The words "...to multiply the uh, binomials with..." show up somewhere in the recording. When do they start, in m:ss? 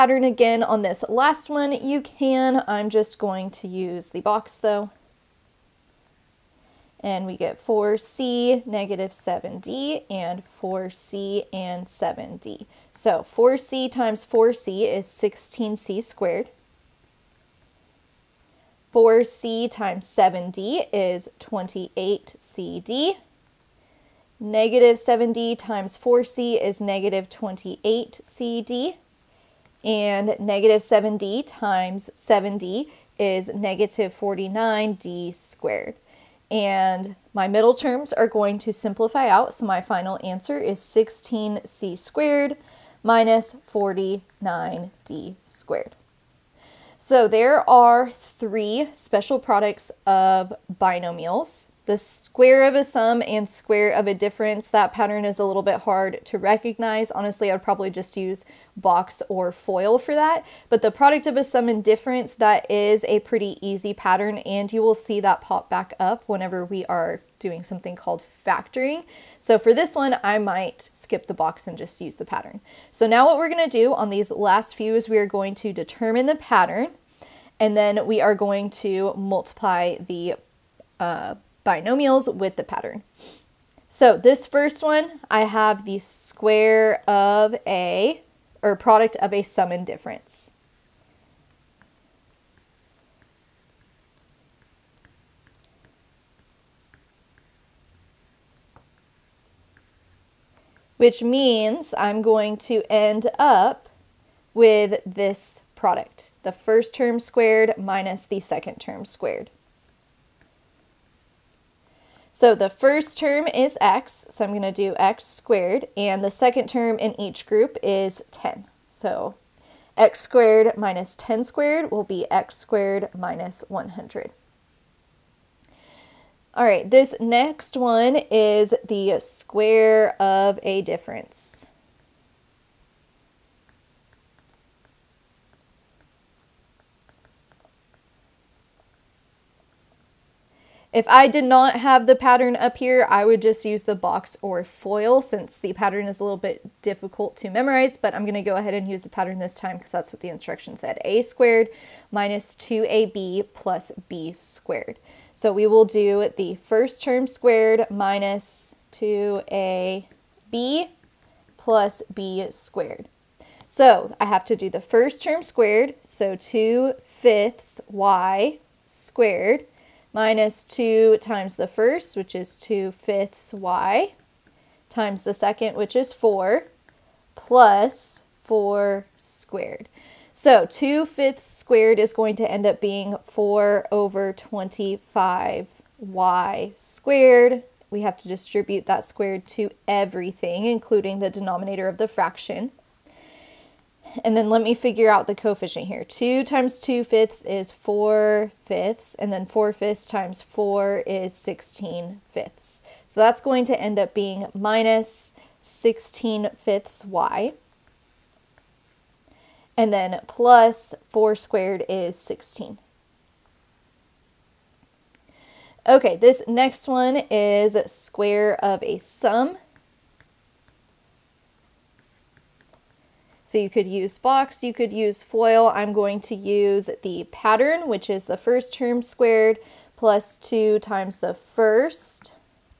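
1:18.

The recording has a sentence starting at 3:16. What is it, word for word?
2 times 2 fifths is 4 fifths, and then 4 fifths times 4 is 16 fifths.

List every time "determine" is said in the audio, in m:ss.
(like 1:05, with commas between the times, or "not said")
1:15.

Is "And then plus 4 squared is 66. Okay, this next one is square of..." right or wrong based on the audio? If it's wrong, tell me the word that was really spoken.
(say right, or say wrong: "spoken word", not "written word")
wrong: "16", not "66".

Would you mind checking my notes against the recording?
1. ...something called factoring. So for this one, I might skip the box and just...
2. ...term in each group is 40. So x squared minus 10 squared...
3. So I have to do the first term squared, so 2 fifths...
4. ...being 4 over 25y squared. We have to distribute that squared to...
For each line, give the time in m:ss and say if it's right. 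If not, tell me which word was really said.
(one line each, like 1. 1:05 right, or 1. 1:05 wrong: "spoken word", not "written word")
1. 1:07 right
2. 1:56 wrong: "10", not "40"
3. 2:43 right
4. 3:02 right.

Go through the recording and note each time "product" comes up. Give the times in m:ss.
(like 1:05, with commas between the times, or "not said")
0:49, 1:00, 1:28, 1:45.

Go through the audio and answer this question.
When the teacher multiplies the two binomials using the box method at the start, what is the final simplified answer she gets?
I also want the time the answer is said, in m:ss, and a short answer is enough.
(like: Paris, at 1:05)
16c^2 - 49d^2, at 0:40.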